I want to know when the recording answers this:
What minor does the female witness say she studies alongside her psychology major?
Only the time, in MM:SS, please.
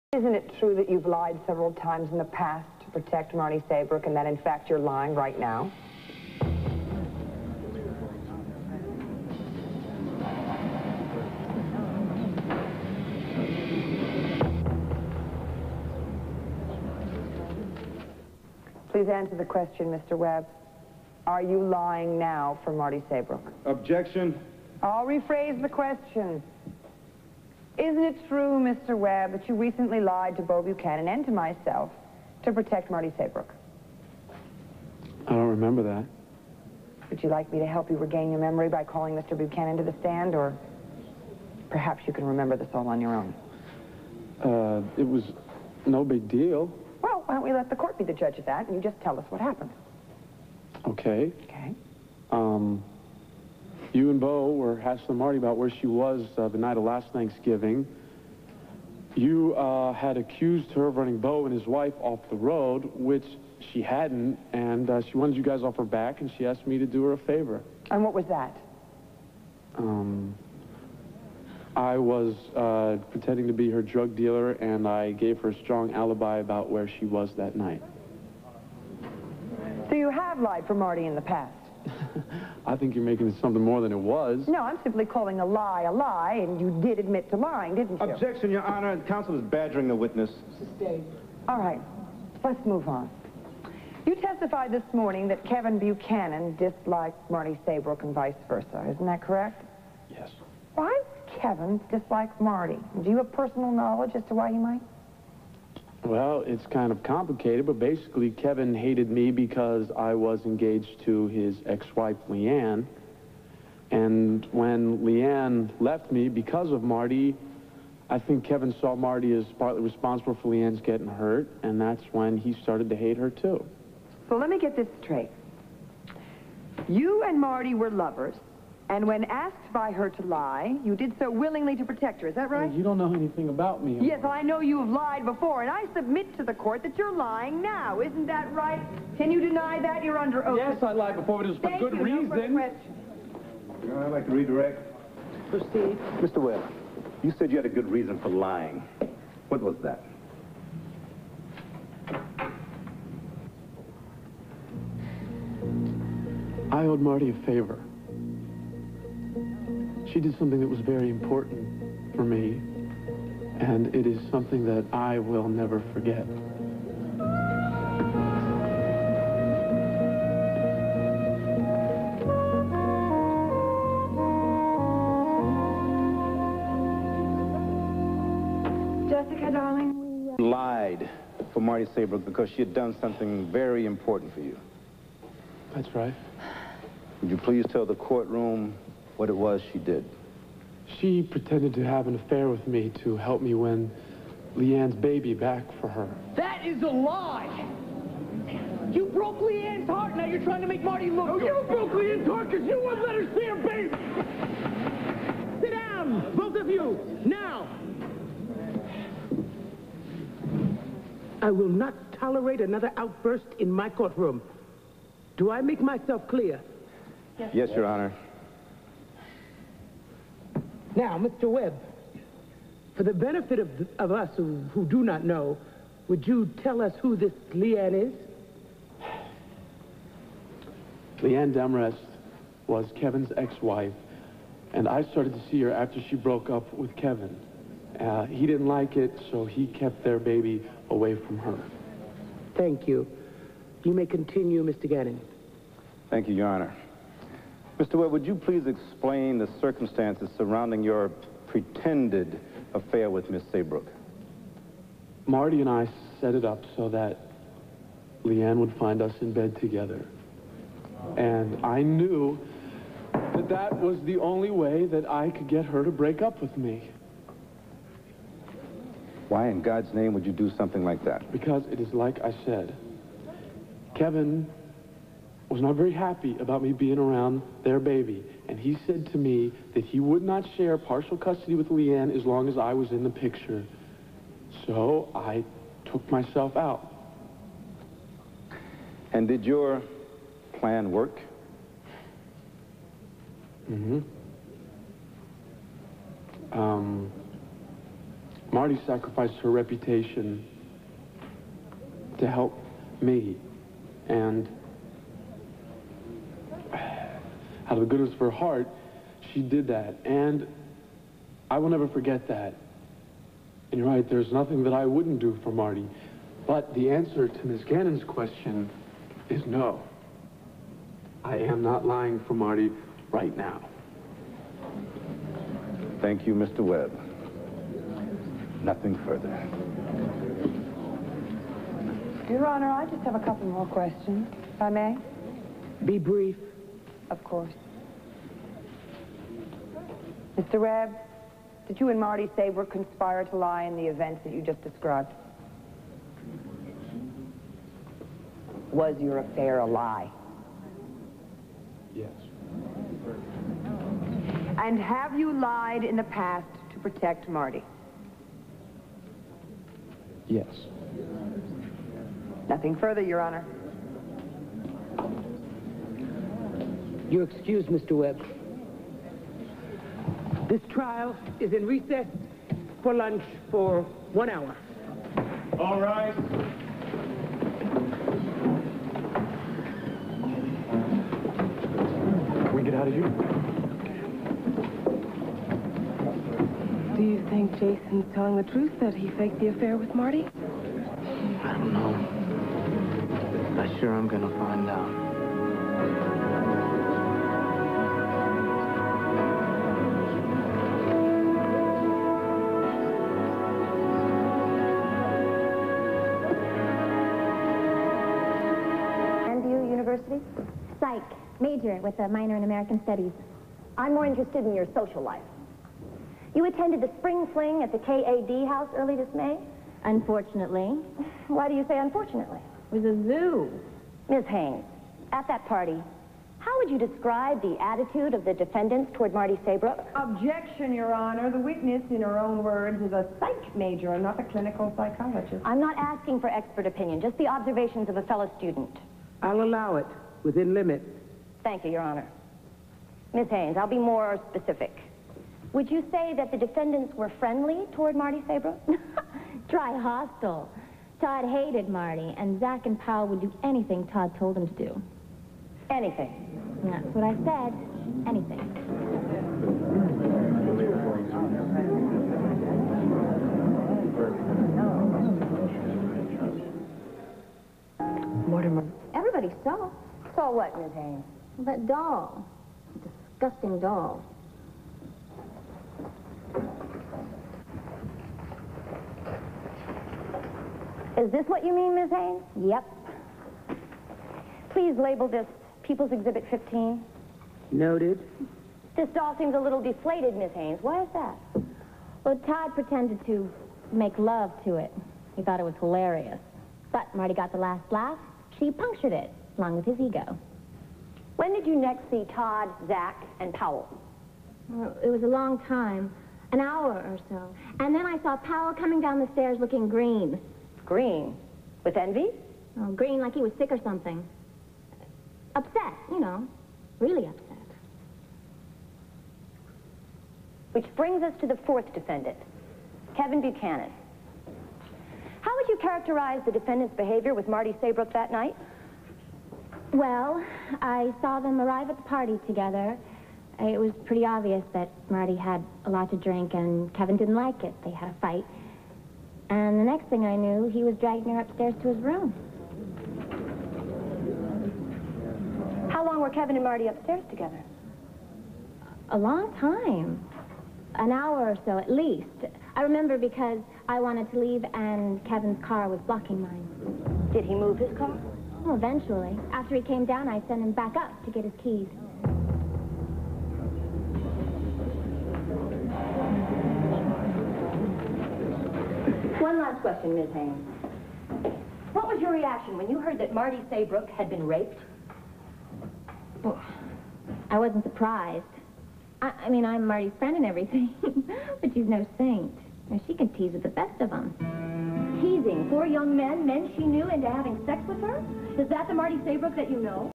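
06:52.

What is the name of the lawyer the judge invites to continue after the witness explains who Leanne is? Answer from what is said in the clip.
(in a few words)
Mr. Gannon.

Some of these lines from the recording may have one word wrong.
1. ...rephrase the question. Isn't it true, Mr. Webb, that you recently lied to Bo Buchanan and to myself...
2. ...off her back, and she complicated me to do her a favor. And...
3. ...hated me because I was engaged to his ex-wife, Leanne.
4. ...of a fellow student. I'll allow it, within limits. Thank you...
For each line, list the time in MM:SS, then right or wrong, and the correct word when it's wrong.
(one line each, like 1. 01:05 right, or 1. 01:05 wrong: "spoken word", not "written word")
1. 00:25 right
2. 01:05 wrong: "asked", not "complicated"
3. 01:48 right
4. 07:17 right.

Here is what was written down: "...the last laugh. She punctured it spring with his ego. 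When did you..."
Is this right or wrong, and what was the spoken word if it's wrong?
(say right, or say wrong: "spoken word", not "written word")
wrong: "along", not "spring".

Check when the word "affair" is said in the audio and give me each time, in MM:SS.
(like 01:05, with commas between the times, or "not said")
03:12, 04:12, 05:49, 06:29.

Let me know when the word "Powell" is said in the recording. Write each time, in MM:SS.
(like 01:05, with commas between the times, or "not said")
07:32, 08:23, 08:28.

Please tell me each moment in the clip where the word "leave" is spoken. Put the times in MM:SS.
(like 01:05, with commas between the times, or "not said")
09:14.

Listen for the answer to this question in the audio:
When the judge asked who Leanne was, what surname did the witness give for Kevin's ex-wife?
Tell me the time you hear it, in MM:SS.
03:51.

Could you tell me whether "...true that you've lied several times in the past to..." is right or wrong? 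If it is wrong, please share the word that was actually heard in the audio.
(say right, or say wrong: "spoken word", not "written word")
right.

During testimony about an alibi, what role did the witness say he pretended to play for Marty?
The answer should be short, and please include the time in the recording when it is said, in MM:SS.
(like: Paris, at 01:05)
Her drug dealer, at 01:13.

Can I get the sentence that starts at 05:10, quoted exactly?
And I will never forget that.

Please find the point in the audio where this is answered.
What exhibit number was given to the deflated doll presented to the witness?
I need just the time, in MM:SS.
08:06.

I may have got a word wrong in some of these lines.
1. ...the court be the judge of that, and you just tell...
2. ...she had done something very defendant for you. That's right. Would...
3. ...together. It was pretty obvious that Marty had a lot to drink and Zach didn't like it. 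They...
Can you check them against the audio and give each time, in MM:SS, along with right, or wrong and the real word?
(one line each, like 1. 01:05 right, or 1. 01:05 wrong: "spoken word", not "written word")
1. 00:47 right
2. 03:02 wrong: "important", not "defendant"
3. 08:52 wrong: "Kevin", not "Zach".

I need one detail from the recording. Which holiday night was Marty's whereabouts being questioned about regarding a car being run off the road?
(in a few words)
Thanksgiving.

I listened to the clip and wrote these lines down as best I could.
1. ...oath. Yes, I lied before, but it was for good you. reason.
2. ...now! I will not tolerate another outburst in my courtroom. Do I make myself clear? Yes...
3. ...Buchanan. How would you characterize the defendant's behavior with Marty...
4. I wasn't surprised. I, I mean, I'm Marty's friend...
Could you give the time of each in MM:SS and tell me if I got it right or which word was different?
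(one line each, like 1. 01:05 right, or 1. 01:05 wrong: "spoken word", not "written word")
1. 02:20 right
2. 03:27 right
3. 08:43 right
4. 09:37 right.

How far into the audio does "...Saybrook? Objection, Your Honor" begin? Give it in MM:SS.
07:09.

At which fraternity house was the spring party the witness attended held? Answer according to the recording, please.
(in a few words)
KAD house.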